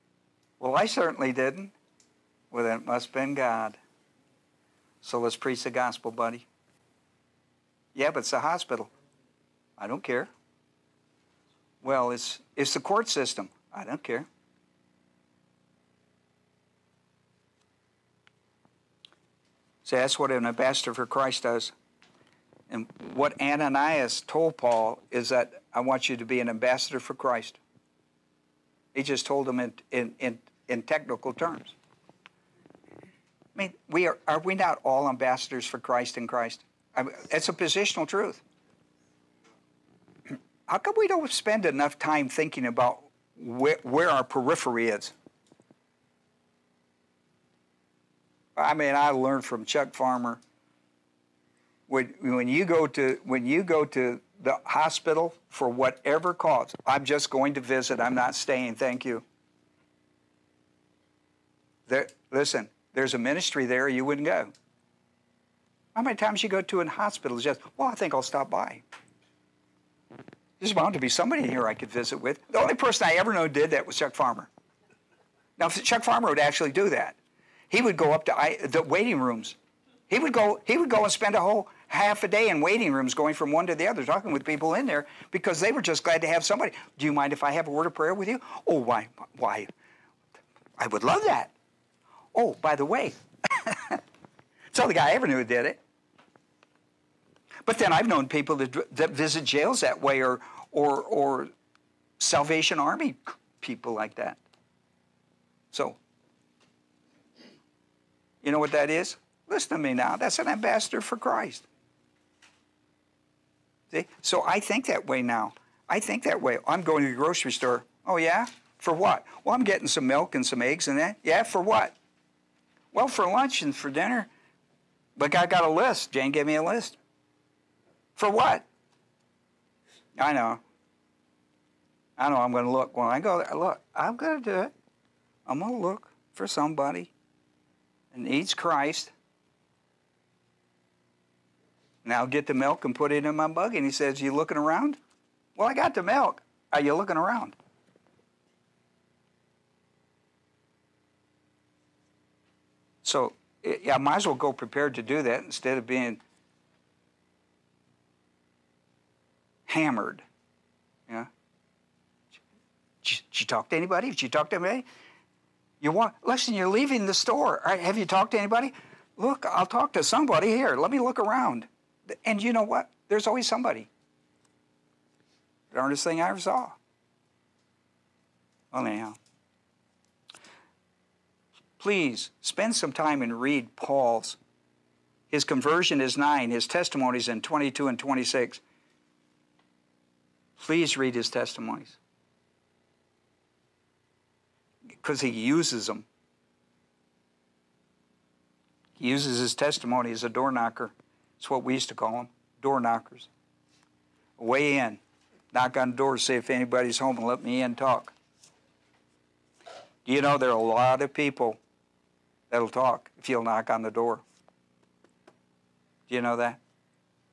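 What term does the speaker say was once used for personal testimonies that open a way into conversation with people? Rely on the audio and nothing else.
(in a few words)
door knockers.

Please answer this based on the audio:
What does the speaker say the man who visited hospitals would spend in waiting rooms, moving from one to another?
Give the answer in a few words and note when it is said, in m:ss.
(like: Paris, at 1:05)
half a day, at 1:21.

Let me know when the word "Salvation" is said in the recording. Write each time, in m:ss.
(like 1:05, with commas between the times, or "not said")
1:42.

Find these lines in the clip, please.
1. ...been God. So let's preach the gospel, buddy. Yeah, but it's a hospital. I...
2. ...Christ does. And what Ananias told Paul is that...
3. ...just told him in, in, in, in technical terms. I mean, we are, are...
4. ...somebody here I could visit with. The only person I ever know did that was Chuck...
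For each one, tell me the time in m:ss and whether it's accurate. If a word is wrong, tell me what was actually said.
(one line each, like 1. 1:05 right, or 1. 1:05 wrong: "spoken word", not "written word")
1. 0:03 right
2. 0:21 right
3. 0:29 right
4. 1:11 right.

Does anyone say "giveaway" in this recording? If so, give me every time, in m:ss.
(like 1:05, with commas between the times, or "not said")
not said.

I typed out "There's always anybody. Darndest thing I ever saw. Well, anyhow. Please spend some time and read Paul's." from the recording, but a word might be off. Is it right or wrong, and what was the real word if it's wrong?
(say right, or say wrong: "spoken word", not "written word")
wrong: "somebody", not "anybody".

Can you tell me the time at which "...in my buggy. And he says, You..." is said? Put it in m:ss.
2:23.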